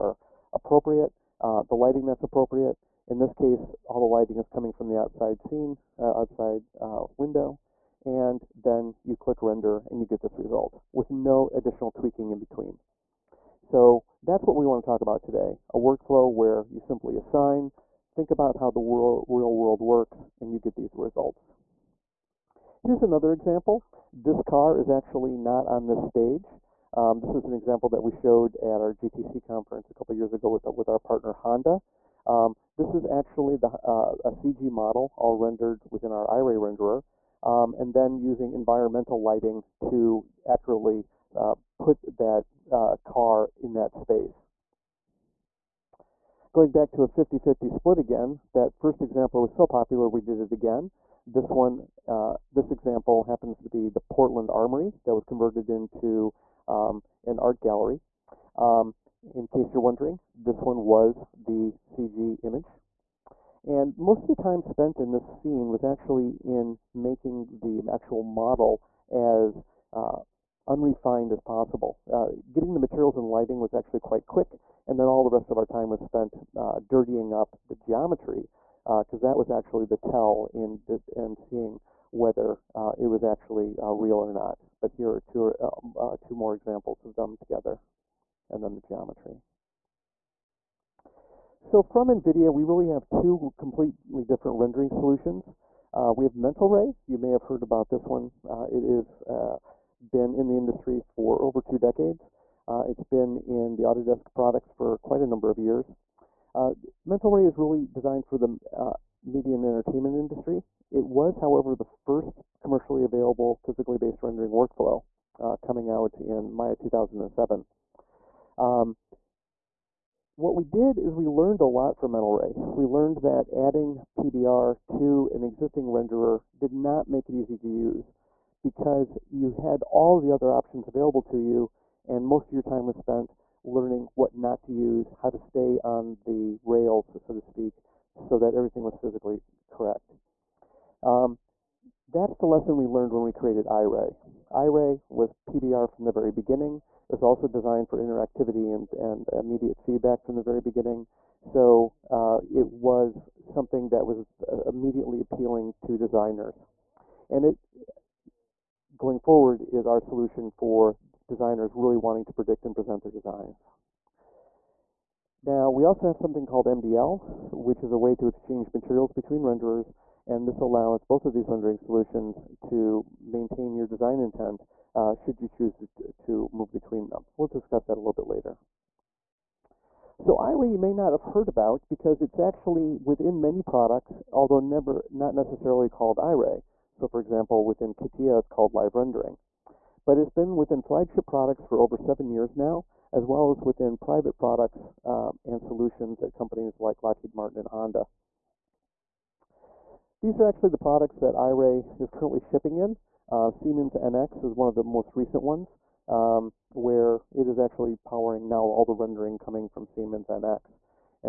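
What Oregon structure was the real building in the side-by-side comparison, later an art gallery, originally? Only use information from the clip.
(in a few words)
Portland Armory.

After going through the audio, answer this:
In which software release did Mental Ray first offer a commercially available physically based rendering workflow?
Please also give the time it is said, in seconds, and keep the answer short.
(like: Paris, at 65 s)
Maya 2007, at 116 s.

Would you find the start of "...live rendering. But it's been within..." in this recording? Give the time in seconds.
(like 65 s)
188 s.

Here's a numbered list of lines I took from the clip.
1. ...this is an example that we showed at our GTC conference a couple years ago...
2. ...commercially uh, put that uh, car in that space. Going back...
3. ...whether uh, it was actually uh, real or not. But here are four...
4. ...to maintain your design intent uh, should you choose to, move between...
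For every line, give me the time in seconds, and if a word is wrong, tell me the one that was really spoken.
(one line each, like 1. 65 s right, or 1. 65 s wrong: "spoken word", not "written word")
1. 27 s right
2. 40 s wrong: "accurately", not "commercially"
3. 82 s wrong: "two", not "four"
4. 172 s right.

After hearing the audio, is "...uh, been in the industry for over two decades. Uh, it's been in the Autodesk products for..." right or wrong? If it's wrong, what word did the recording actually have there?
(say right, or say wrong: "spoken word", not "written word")
right.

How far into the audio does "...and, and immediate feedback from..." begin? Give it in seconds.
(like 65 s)
148 s.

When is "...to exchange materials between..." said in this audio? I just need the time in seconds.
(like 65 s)
168 s.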